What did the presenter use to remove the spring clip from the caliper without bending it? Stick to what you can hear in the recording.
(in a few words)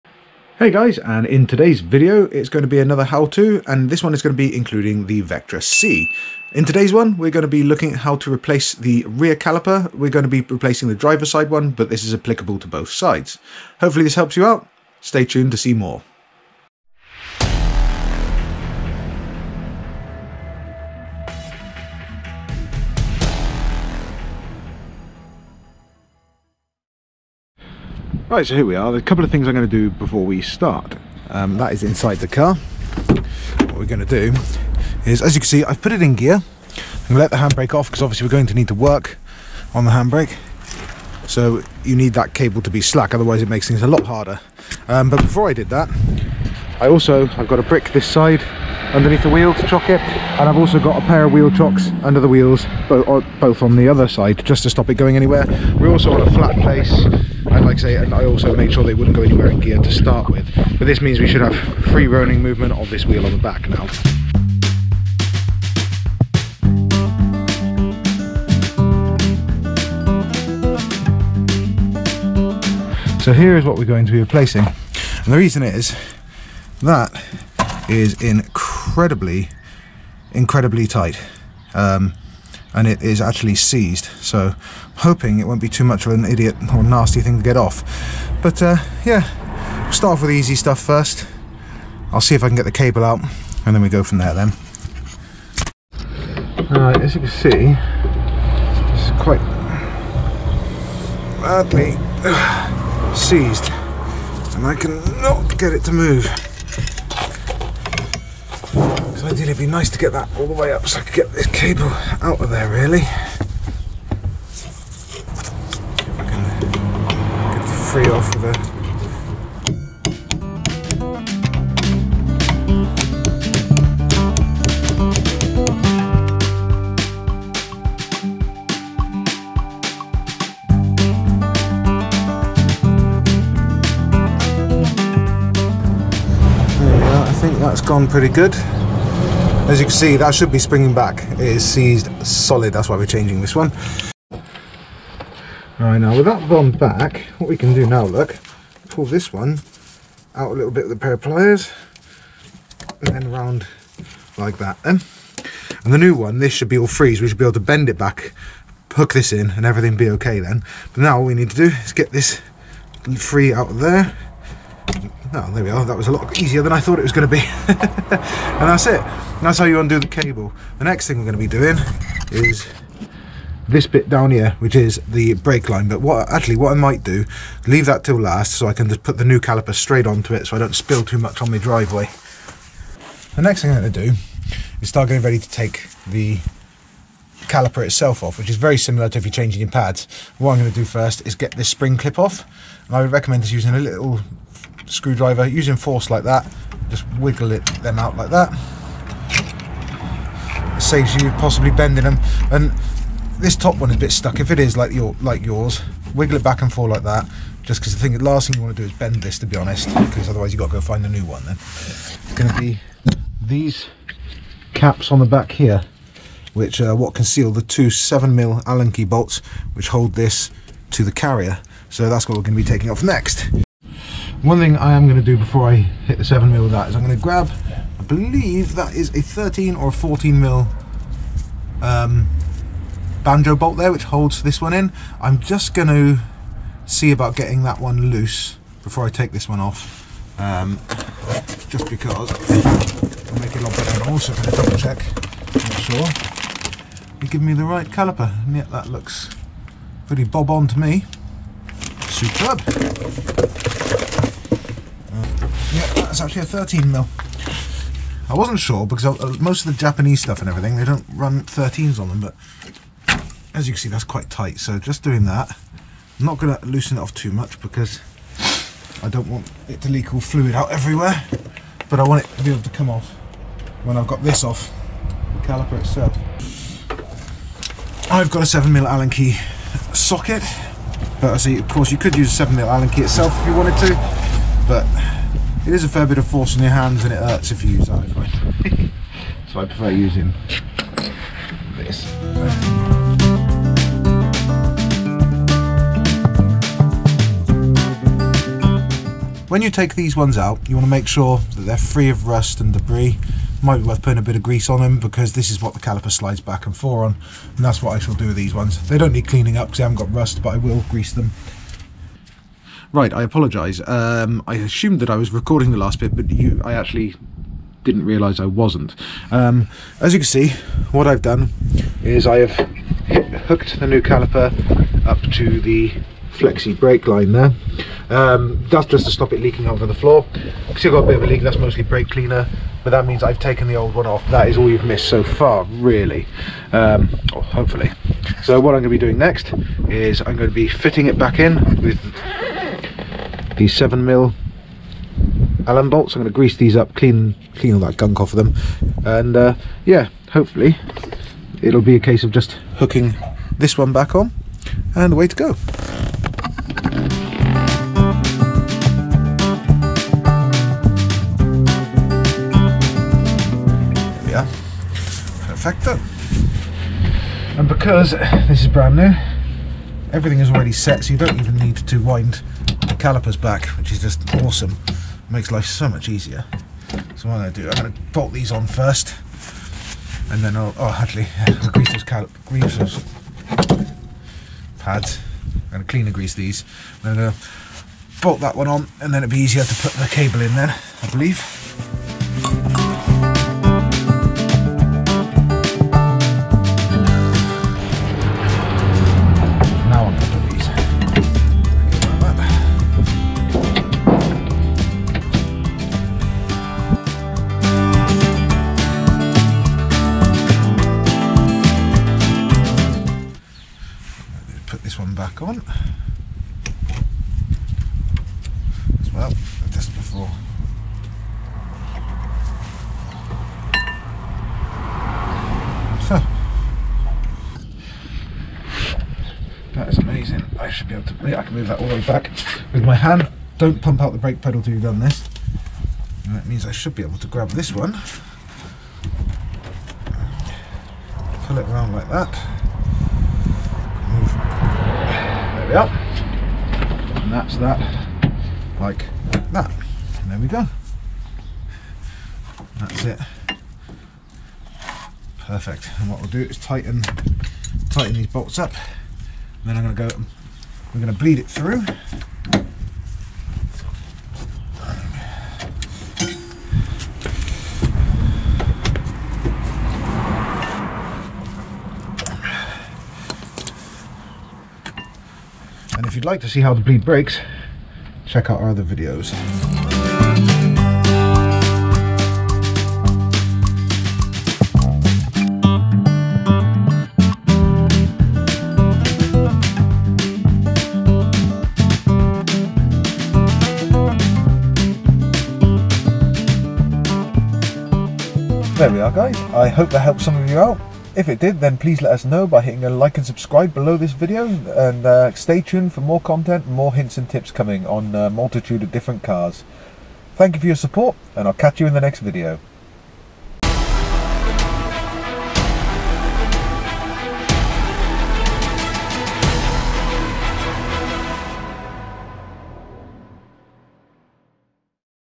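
Little screwdriver.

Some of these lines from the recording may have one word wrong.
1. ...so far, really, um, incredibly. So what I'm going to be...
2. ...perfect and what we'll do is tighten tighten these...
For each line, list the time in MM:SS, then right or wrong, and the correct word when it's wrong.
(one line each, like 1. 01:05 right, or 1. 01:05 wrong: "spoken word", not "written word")
1. 05:35 wrong: "hopefully", not "incredibly"
2. 07:35 right.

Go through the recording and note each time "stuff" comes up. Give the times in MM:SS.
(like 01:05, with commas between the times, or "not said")
01:30, 04:20.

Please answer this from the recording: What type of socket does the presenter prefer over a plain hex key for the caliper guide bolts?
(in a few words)
7 mil Allen key socket.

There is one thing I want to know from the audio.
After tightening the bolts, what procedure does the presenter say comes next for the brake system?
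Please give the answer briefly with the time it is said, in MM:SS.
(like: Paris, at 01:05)
Bleed it, at 07:41.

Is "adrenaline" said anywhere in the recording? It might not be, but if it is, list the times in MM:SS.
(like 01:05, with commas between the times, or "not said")
not said.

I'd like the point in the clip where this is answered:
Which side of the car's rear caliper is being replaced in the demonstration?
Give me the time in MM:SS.
00:10.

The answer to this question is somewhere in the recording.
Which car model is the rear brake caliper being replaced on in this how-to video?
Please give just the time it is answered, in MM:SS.
00:05.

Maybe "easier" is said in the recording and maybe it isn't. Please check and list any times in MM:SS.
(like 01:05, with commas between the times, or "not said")
02:46, 06:16, 06:29.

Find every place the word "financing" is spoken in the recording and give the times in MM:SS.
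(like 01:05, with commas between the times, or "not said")
not said.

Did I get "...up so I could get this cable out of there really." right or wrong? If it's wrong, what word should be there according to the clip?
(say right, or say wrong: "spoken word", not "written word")
right.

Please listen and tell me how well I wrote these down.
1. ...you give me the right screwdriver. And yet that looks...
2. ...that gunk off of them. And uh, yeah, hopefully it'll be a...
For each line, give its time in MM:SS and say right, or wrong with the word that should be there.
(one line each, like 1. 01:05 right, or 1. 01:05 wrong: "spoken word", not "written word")
1. 04:07 wrong: "caliper", not "screwdriver"
2. 05:47 right.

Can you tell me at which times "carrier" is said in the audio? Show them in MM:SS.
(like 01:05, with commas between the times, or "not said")
03:41.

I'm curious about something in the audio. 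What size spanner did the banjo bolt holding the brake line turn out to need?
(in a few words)
13 mil.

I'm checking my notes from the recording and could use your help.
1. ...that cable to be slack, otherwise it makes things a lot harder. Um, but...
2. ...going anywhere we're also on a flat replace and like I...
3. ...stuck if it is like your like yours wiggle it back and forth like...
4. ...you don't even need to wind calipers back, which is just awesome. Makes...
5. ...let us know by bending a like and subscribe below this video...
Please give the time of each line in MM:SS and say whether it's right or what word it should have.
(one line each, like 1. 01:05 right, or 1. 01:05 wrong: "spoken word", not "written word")
1. 00:42 right
2. 00:54 wrong: "place", not "replace"
3. 03:24 right
4. 06:11 right
5. 08:22 wrong: "hitting", not "bending".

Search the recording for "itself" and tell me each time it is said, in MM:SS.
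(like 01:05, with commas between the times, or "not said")
03:07, 04:35, 04:43.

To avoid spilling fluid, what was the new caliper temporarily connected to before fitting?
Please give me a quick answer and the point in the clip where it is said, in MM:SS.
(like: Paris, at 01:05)
Flexi brake line, at 05:26.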